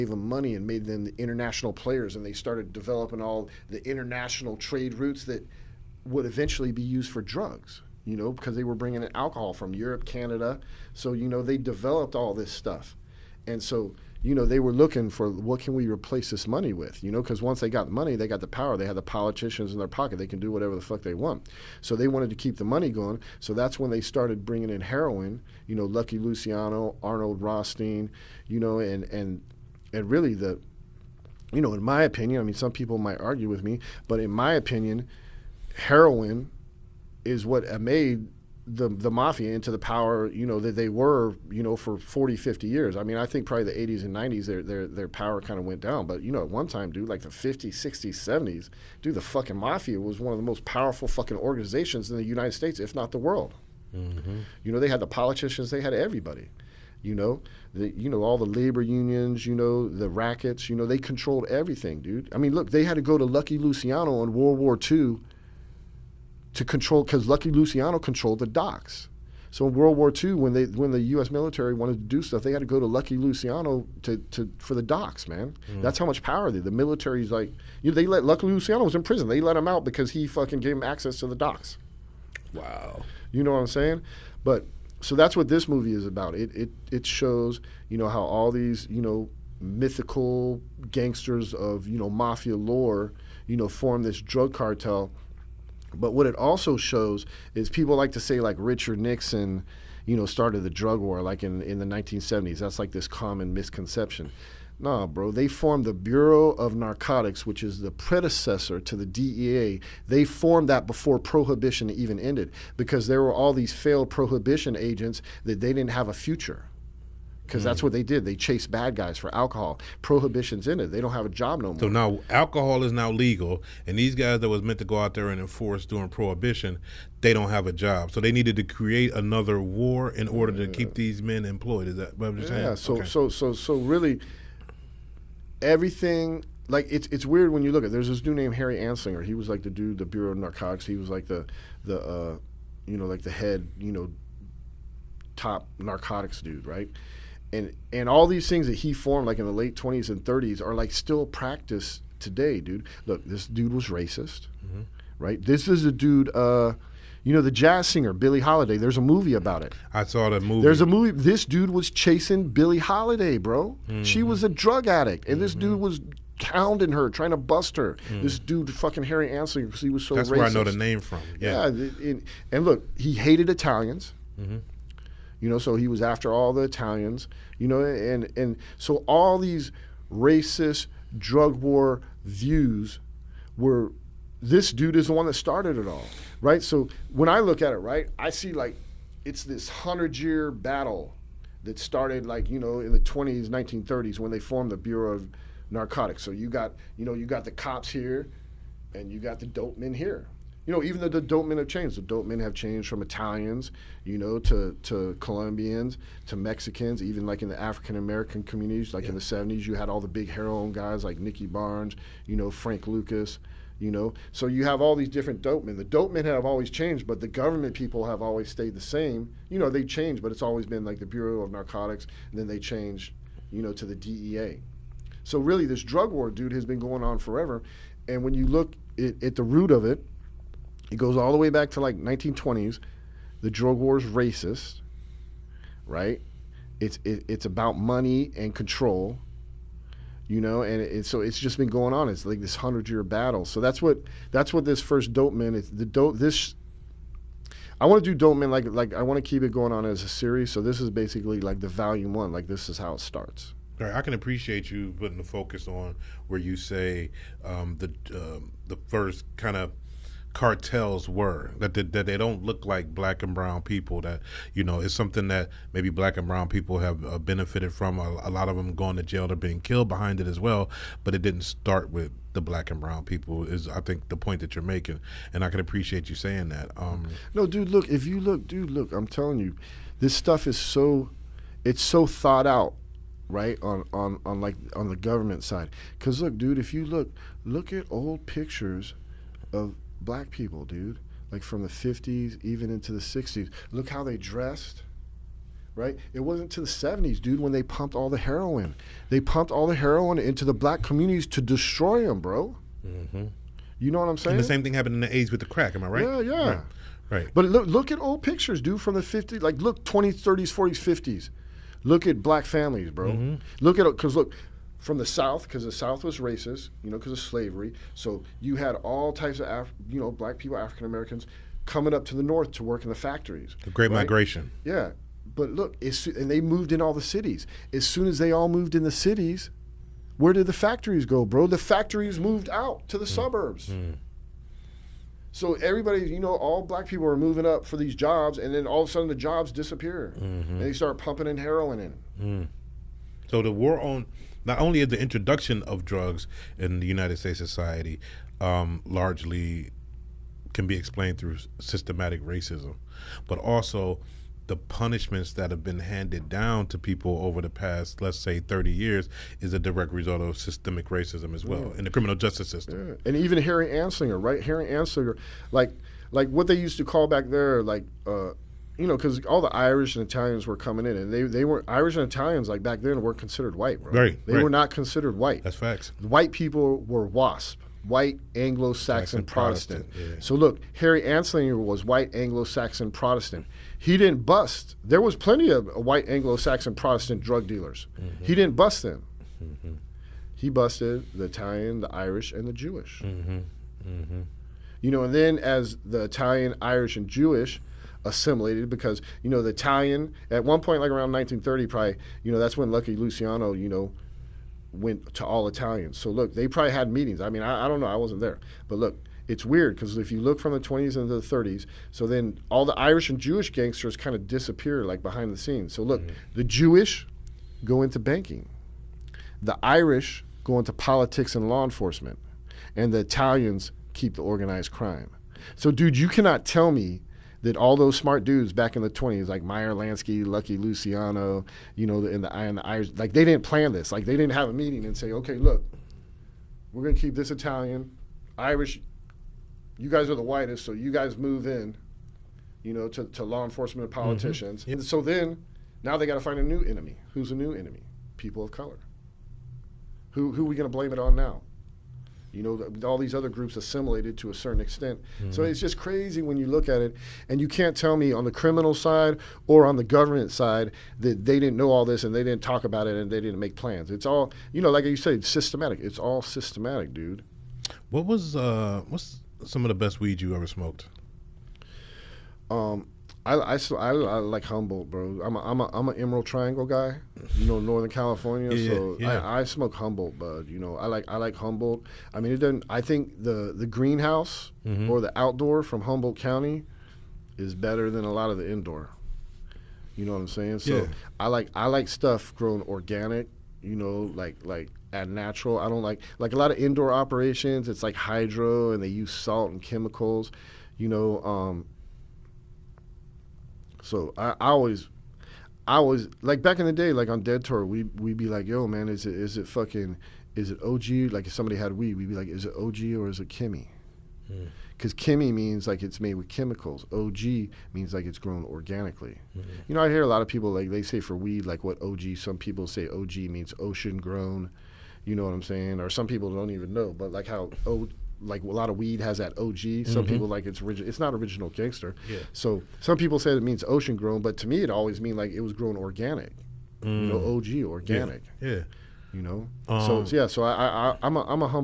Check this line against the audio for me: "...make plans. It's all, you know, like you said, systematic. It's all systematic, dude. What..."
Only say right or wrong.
right.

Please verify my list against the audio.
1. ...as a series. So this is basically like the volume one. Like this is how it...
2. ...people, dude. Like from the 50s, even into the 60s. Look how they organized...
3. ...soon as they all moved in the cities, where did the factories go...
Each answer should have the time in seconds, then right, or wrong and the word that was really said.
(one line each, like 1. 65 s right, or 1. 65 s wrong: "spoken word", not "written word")
1. 249 s right
2. 290 s wrong: "dressed", not "organized"
3. 327 s right.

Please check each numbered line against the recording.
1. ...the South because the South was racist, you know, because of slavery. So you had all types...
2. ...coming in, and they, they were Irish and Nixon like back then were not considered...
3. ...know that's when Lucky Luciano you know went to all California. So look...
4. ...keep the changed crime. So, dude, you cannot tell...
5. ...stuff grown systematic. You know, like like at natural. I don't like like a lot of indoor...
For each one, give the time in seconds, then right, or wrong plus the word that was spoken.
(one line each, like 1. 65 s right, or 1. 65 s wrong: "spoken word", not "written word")
1. 314 s right
2. 370 s wrong: "Italians", not "Nixon"
3. 402 s wrong: "Italians", not "California"
4. 423 s wrong: "organized", not "changed"
5. 491 s wrong: "organic", not "systematic".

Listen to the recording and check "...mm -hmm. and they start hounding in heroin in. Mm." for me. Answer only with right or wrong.
wrong.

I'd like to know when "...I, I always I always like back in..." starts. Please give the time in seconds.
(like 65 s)
504 s.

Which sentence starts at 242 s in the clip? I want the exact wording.
It's like this hundred year battle.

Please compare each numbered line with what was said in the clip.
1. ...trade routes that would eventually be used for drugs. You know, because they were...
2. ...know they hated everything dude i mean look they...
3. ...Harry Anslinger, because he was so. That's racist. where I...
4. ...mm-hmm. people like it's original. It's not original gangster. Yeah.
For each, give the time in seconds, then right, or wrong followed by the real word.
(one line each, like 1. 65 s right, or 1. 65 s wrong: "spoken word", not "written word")
1. 4 s right
2. 60 s wrong: "controlled", not "hated"
3. 169 s right
4. 529 s right.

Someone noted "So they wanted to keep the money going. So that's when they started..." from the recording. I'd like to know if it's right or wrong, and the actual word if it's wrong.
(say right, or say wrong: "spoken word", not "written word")
right.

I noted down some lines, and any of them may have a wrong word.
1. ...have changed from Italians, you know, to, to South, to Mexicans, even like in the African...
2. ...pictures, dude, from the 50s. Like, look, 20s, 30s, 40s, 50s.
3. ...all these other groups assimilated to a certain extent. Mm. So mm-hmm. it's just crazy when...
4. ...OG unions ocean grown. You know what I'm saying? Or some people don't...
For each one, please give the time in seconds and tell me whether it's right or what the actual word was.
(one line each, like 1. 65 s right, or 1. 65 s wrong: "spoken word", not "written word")
1. 202 s wrong: "Colombians", not "South"
2. 308 s right
3. 452 s right
4. 522 s wrong: "means", not "unions".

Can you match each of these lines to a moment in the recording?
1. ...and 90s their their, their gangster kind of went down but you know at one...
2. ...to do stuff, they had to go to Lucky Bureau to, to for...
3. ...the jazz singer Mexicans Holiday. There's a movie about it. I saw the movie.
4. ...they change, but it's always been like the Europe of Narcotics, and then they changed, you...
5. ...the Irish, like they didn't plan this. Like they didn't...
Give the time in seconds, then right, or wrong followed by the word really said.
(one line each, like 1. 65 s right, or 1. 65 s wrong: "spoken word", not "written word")
1. 44 s wrong: "power", not "gangster"
2. 71 s wrong: "Luciano", not "Bureau"
3. 157 s wrong: "Billie", not "Mexicans"
4. 219 s wrong: "Bureau", not "Europe"
5. 432 s right.